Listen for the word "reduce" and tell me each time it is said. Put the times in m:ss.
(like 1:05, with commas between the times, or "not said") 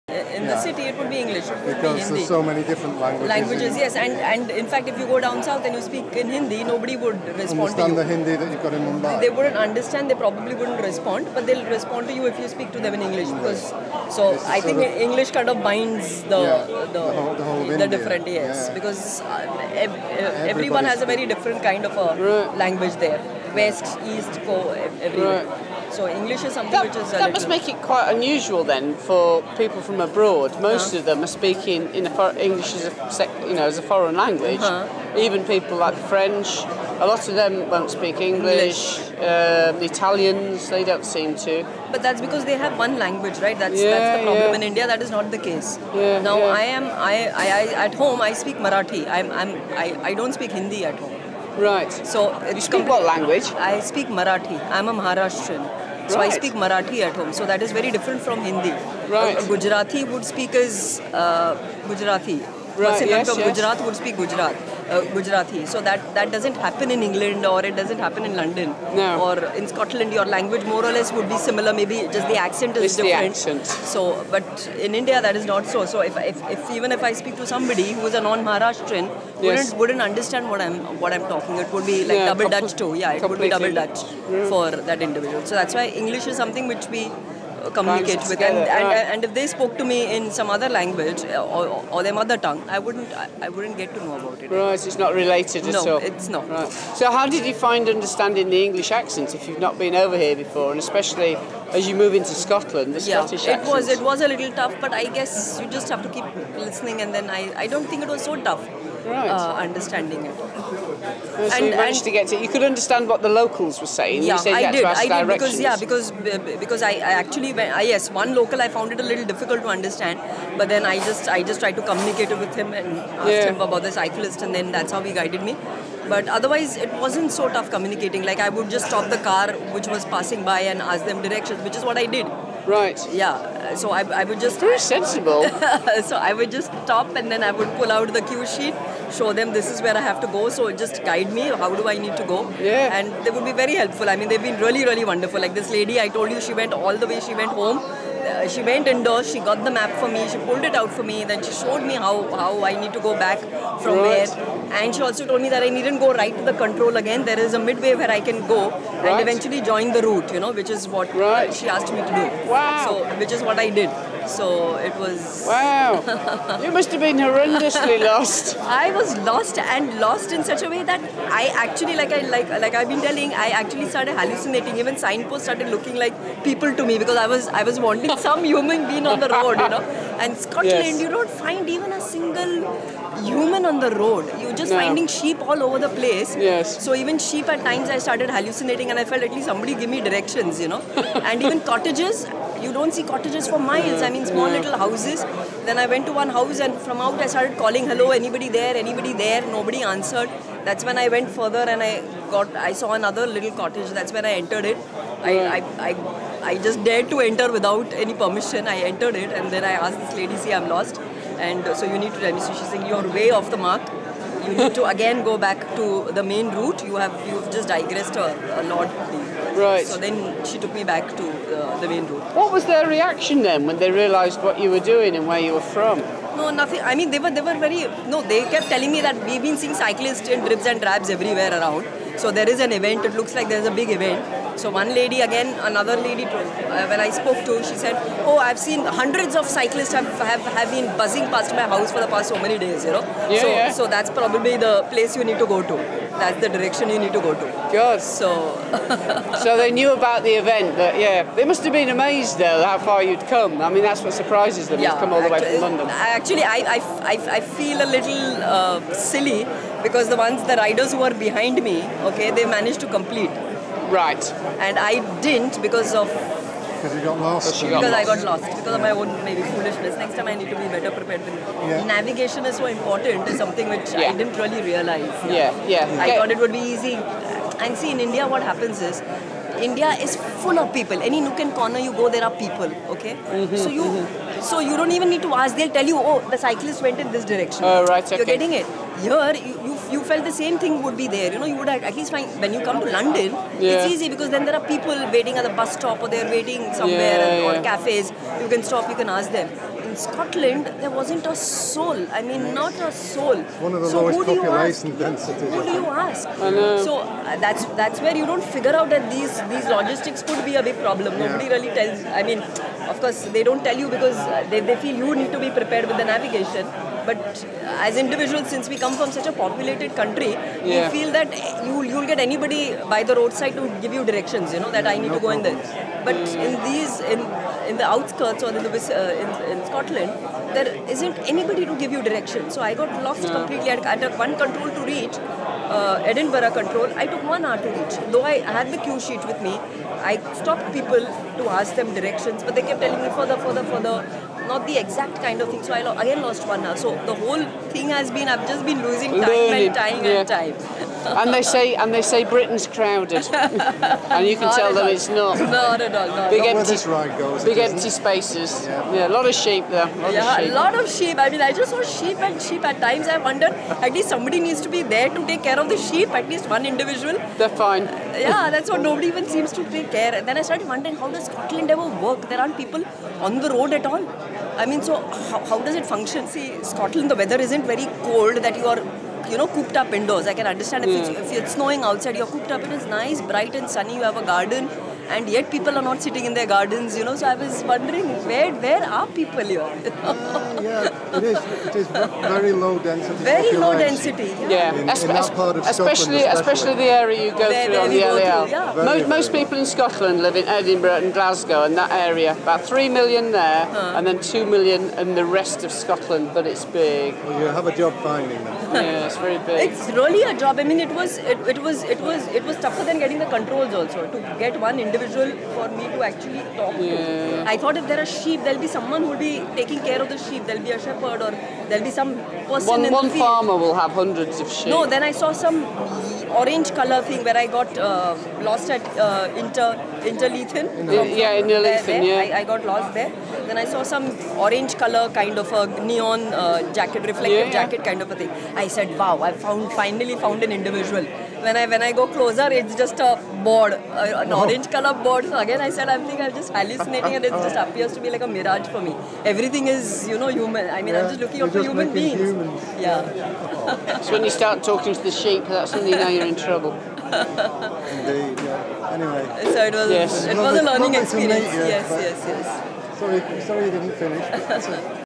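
not said.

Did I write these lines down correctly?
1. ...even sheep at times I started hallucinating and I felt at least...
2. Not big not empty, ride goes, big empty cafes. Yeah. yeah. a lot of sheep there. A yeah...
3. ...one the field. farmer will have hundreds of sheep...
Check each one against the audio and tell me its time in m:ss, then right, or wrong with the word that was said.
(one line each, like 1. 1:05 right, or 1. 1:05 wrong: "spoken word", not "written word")
1. 3:06 right
2. 5:56 wrong: "spaces", not "cafes"
3. 7:02 right.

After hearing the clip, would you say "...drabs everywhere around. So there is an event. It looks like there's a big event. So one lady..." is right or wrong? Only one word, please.
right.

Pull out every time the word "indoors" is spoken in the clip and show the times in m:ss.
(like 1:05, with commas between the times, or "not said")
2:28, 6:19.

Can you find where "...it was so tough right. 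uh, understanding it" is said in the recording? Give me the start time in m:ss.
1:48.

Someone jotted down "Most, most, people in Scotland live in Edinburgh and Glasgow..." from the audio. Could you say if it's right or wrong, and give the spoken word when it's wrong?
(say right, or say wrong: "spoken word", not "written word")
right.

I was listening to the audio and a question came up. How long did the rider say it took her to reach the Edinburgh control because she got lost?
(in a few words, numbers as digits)
1 hour.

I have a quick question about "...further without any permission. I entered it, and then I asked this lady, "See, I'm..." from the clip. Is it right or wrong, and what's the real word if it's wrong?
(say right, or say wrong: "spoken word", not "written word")
wrong: "enter", not "further".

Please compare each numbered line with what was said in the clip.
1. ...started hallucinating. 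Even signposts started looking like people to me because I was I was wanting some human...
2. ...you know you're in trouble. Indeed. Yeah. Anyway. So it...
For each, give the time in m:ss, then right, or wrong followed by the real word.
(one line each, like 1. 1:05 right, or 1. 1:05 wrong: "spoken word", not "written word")
1. 2:53 right
2. 7:35 right.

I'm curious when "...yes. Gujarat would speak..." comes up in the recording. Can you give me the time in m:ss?
1:03.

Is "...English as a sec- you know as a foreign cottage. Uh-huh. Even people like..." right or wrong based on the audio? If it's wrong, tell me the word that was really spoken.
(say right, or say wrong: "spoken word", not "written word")
wrong: "language", not "cottage".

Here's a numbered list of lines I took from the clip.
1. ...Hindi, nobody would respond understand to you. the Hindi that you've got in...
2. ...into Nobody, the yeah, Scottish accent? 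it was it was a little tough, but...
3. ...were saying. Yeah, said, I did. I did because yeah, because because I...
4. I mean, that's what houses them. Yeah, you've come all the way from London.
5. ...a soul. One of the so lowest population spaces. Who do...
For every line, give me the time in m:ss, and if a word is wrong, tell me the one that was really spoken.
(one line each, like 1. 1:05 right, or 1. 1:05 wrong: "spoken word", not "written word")
1. 0:06 right
2. 1:42 wrong: "Scotland", not "Nobody"
3. 1:53 right
4. 4:13 wrong: "surprises", not "houses"
5. 5:02 wrong: "densities", not "spaces".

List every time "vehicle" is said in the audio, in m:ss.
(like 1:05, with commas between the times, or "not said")
not said.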